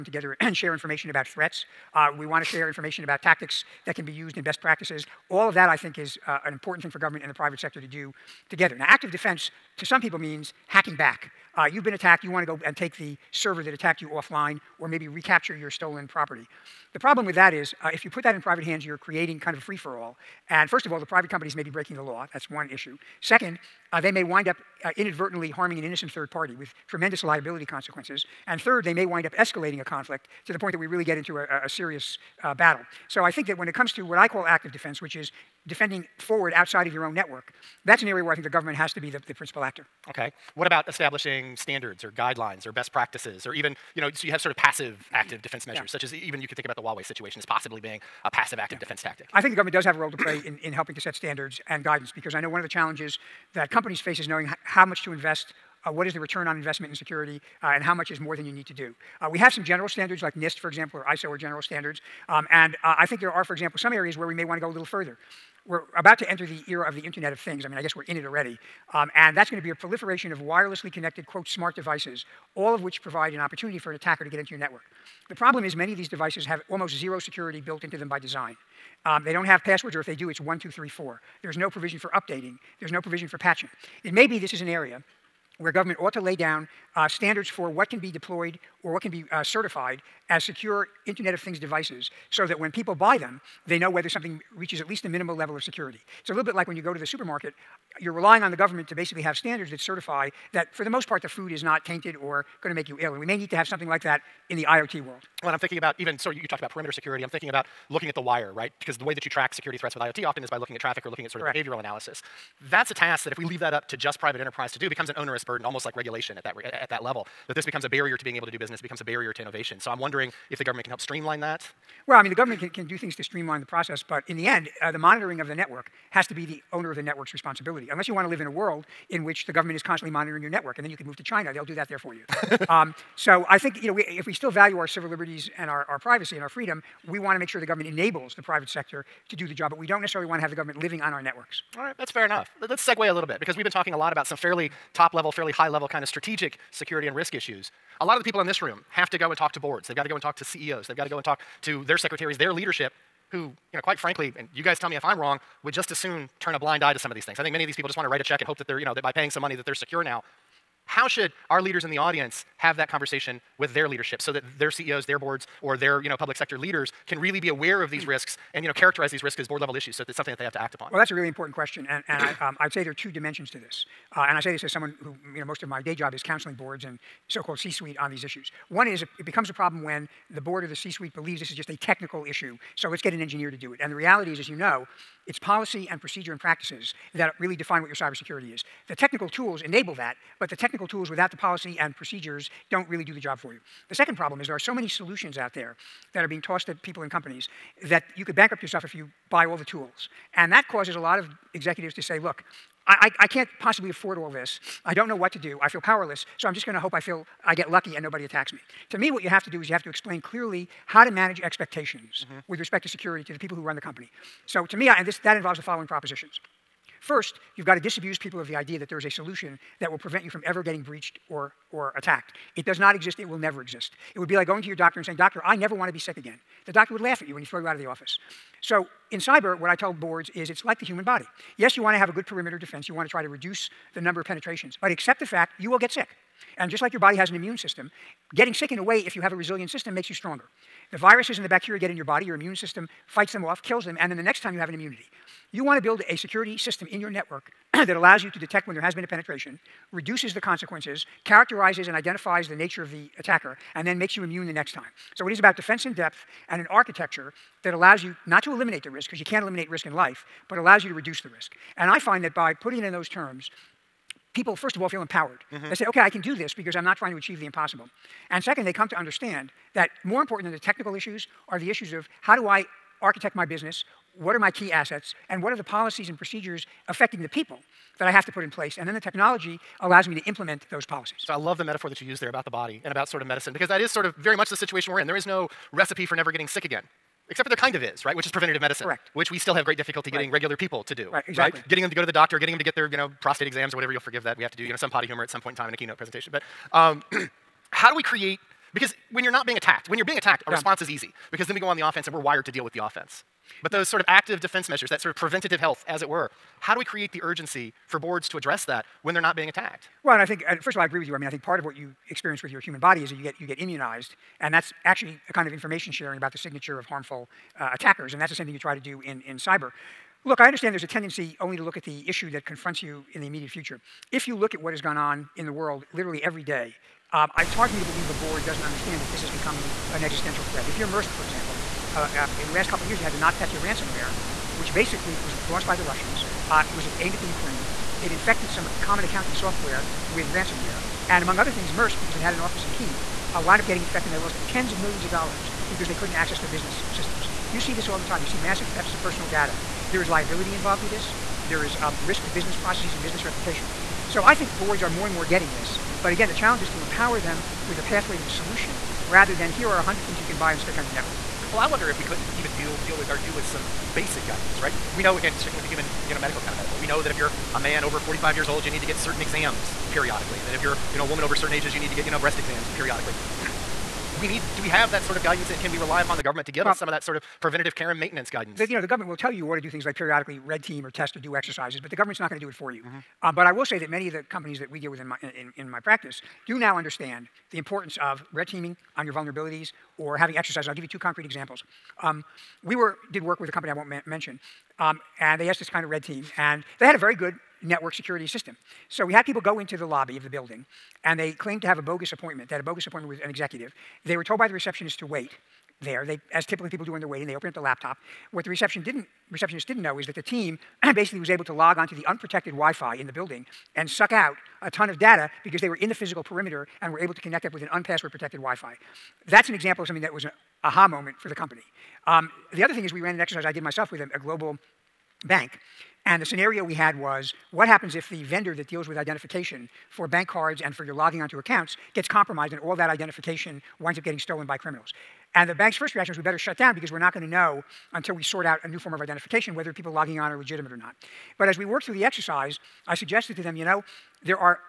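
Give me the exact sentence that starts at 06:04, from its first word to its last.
We know, again, sticking with the human, you know, medical kind of mm-hmm.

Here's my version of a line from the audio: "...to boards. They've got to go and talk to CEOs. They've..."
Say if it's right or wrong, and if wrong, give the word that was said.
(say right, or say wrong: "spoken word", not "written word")
right.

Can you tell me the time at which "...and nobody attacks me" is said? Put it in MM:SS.
03:27.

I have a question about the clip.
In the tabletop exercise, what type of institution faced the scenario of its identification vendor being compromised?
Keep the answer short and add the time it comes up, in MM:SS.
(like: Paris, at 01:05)
global bank, at 07:04.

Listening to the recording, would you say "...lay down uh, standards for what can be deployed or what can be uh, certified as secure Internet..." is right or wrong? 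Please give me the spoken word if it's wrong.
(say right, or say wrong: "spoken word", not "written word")
right.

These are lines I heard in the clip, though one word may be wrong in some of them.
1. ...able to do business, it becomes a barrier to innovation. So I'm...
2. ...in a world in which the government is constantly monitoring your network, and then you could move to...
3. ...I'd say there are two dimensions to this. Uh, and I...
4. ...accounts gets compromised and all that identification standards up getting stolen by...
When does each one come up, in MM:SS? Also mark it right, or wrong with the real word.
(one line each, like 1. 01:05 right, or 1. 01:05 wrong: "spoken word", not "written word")
1. 01:58 right
2. 02:08 right
3. 02:52 right
4. 07:11 wrong: "winds", not "standards".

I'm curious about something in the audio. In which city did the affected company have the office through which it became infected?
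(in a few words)
Kiev.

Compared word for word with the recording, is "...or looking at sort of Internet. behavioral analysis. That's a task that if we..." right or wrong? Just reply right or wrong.
wrong.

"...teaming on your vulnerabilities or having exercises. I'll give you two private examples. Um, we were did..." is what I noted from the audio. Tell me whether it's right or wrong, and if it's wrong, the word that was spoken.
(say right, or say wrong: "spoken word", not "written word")
wrong: "concrete", not "private".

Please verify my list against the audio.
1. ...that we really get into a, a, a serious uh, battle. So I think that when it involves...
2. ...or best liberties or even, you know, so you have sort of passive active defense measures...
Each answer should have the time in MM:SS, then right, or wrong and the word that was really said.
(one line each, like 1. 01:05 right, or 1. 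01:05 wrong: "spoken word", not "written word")
1. 00:30 wrong: "comes", not "involves"
2. 00:42 wrong: "practices", not "liberties".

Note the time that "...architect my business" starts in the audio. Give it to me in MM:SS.
04:33.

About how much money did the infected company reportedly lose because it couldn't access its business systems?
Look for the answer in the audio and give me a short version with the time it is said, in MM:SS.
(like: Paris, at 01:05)
tens of millions of dollars, at 05:44.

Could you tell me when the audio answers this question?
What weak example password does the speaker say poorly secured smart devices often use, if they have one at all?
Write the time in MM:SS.
01:20.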